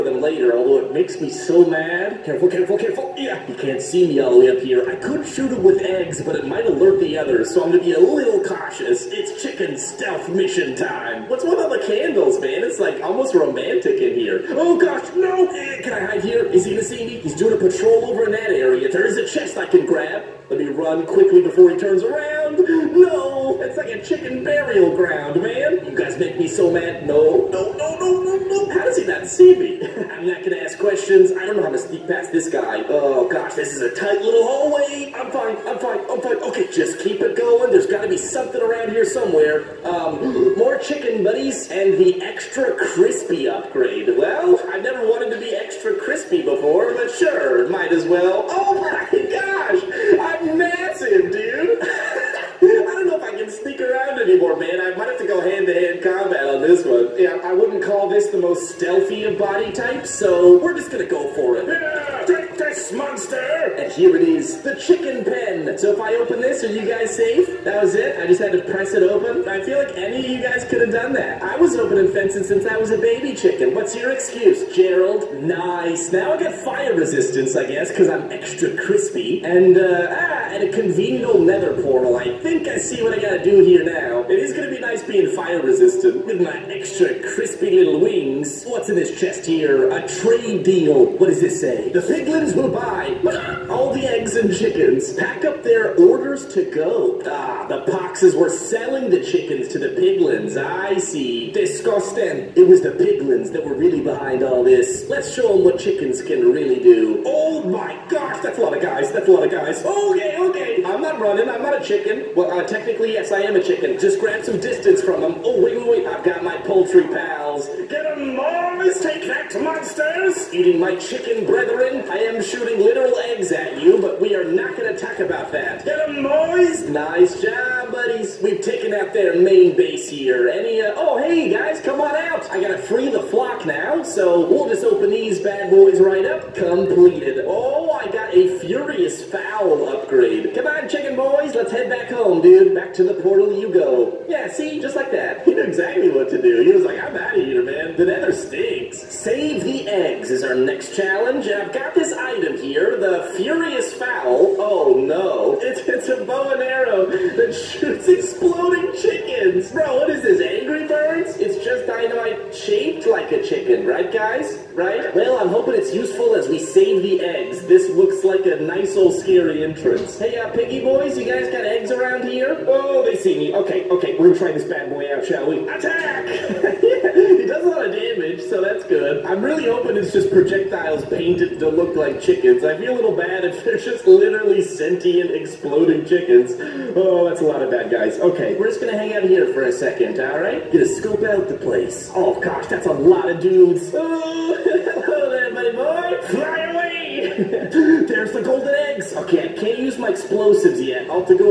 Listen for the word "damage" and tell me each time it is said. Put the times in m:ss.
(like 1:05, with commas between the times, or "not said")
2:57.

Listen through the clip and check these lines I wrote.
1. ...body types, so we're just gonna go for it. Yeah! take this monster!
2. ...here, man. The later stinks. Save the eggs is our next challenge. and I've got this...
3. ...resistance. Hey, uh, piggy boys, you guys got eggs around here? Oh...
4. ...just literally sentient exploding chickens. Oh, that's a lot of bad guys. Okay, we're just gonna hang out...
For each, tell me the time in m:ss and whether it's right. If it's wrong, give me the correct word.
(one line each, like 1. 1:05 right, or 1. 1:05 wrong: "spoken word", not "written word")
1. 0:59 right
2. 2:27 wrong: "nether", not "later"
3. 2:49 wrong: "entrance", not "resistance"
4. 3:03 right.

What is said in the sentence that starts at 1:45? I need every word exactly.
Let's show them what chickens can really do.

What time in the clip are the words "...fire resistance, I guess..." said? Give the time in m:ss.
1:16.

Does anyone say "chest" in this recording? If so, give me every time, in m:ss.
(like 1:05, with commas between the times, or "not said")
0:19, 1:29.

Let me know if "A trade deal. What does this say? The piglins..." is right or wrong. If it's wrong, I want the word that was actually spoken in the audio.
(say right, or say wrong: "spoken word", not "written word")
right.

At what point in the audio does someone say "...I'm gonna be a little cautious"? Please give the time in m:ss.
0:07.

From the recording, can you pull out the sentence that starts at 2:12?
I gotta free the flock now, so we'll just open these bad boys right up.